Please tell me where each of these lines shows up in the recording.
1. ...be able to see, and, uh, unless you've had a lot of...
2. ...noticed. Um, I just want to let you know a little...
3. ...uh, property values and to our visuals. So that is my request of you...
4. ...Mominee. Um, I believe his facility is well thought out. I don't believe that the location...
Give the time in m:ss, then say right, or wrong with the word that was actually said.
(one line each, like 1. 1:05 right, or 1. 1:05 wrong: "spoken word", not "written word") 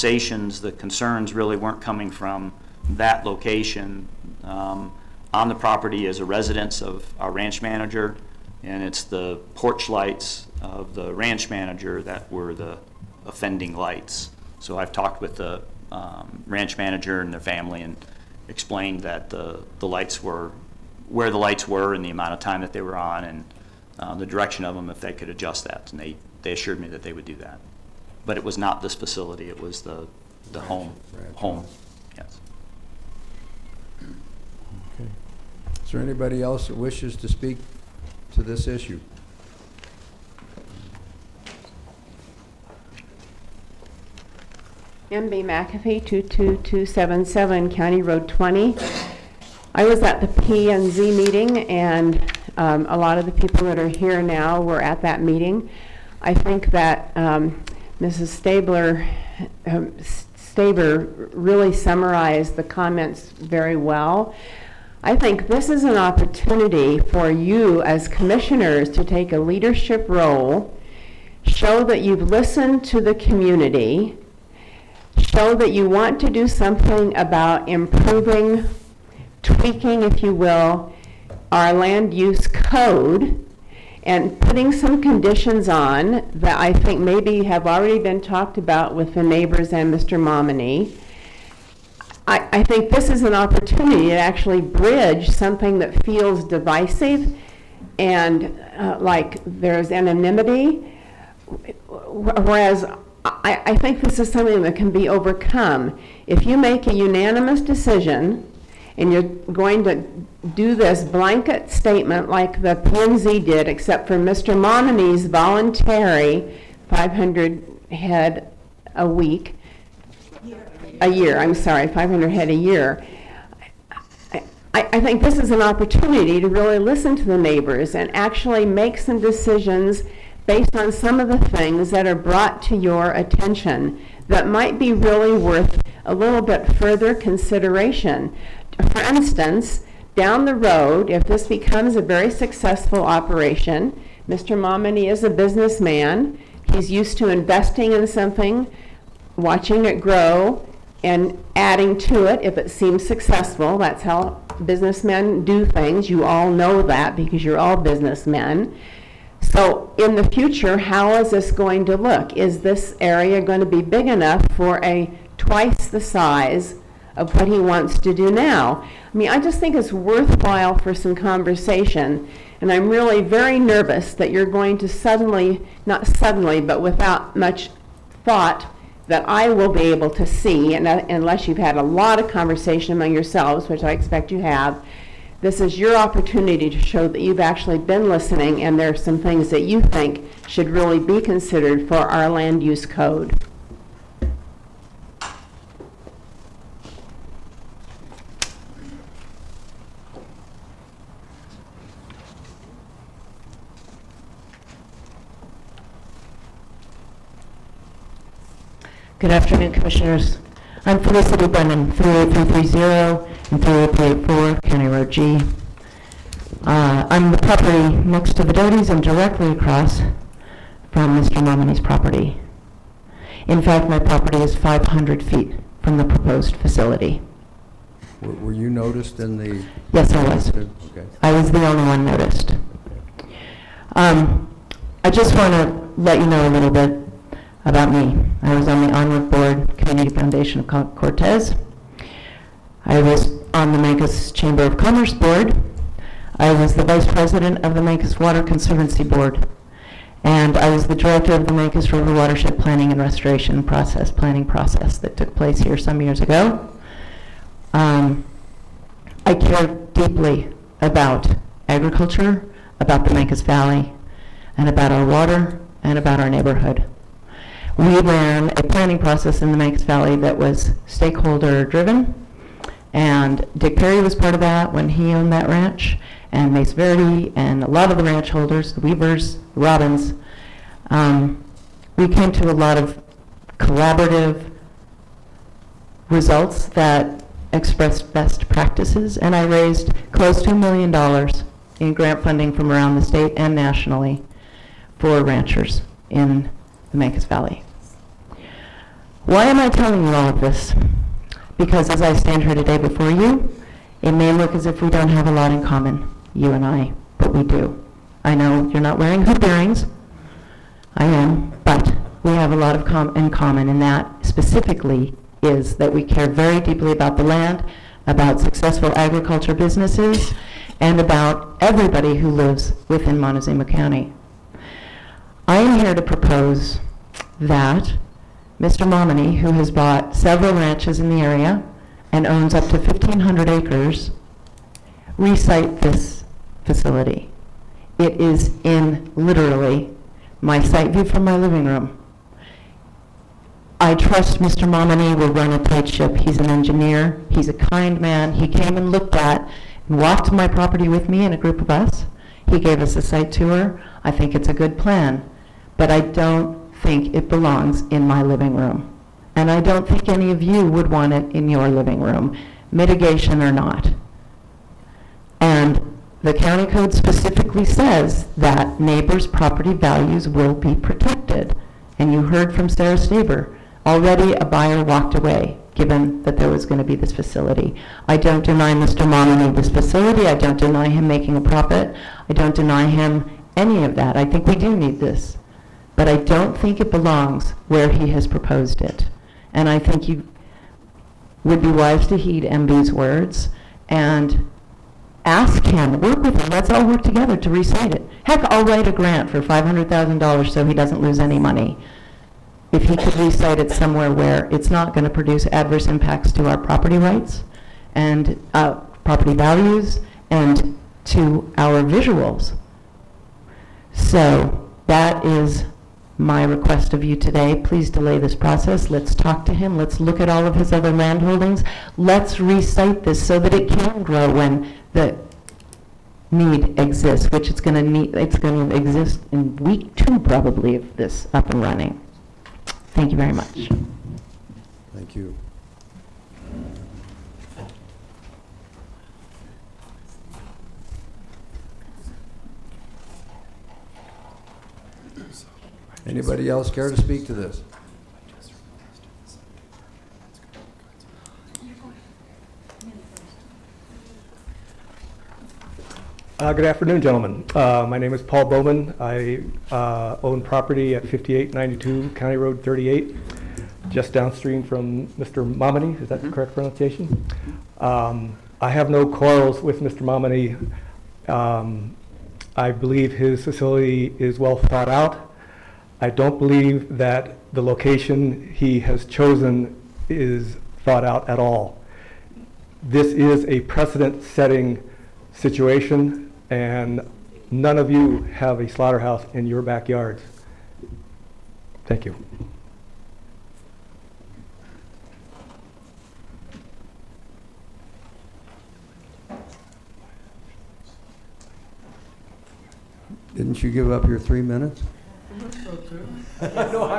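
1. 2:59 right
2. 3:52 right
3. 6:48 right
4. 7:49 right.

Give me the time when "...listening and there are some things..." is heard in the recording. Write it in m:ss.
3:08.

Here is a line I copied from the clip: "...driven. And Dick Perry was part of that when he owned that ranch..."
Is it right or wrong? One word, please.
right.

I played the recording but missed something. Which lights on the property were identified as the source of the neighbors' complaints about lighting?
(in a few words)
Porch lights.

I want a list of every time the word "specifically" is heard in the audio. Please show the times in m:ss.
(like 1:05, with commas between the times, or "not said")
5:14, 6:06.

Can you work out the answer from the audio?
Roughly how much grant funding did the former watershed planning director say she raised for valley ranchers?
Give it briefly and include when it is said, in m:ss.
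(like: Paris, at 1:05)
Close to a million dollars, at 4:50.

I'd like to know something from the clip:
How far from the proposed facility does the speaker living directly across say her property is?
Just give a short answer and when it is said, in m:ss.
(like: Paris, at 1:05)
500 feet, at 3:44.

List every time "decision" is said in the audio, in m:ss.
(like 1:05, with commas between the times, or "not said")
1:47, 2:09.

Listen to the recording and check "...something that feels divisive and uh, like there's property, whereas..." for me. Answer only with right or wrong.
wrong.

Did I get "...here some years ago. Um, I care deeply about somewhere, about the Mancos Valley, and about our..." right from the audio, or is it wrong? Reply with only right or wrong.
wrong.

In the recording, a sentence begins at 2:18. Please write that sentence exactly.
For instance, down the road, if this becomes a very successful operation, Mr.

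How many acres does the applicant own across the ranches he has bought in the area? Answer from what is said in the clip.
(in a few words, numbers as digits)
1,500 acres.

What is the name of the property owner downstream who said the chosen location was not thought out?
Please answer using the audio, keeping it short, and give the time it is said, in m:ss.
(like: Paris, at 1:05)
Paul Bowman, at 7:38.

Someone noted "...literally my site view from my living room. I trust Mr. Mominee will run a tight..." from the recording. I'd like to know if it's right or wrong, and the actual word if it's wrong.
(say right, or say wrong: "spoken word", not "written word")
right.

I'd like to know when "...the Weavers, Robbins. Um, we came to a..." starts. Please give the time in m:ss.
4:38.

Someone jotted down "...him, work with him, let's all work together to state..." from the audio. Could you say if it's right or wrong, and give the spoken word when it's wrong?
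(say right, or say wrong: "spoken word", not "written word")
wrong: "recite", not "state".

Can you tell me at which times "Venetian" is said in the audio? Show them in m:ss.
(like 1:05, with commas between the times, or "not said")
not said.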